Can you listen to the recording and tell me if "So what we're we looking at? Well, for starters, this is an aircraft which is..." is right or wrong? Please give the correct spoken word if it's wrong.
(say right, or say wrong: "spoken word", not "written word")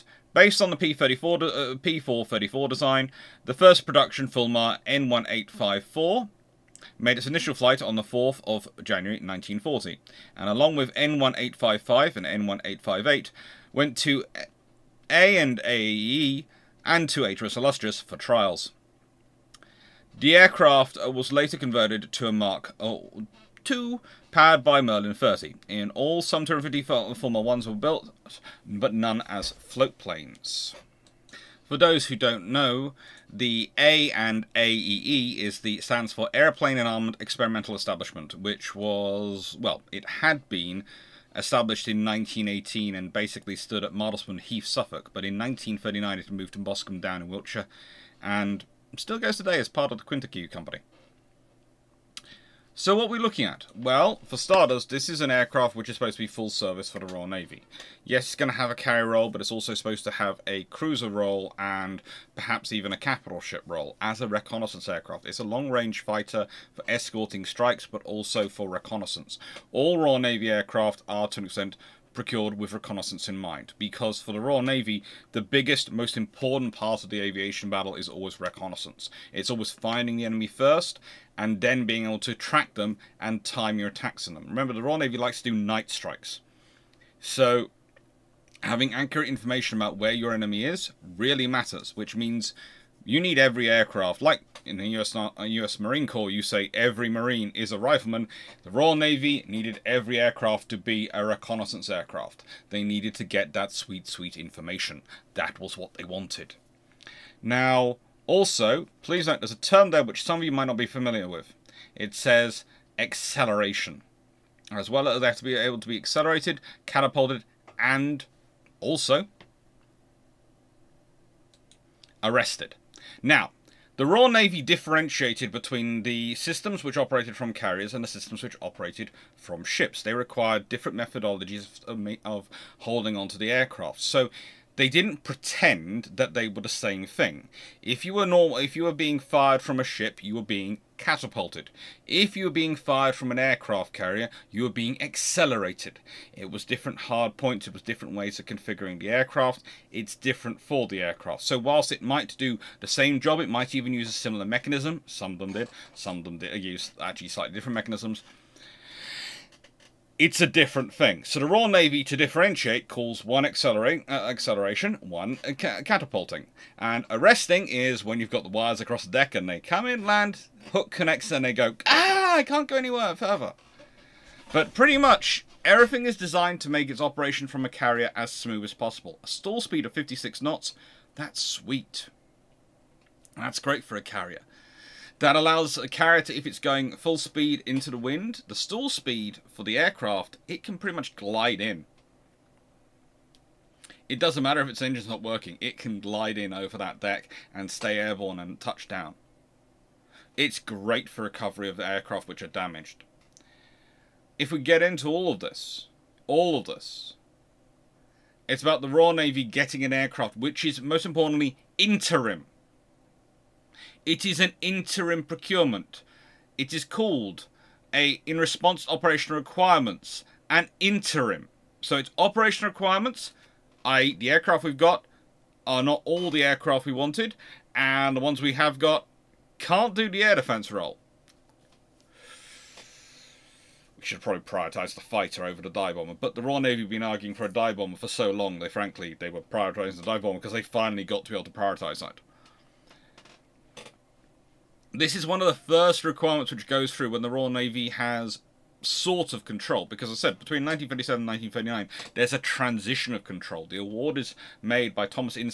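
right.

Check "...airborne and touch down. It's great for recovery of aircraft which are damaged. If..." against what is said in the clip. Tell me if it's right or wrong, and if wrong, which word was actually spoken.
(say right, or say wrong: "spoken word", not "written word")
right.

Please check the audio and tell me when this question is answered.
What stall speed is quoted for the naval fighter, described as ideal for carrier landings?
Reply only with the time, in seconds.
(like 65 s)
179 s.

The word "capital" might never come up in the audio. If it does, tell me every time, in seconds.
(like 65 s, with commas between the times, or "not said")
62 s.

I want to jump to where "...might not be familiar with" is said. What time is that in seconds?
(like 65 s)
110 s.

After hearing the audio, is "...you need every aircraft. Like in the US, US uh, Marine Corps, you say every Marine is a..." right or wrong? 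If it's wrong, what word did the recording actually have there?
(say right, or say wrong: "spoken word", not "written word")
right.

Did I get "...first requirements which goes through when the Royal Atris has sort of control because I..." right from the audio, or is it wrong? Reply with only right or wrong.
wrong.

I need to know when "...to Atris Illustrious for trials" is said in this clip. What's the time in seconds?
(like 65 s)
17 s.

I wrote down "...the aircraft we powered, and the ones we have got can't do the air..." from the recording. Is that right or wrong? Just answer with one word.
wrong.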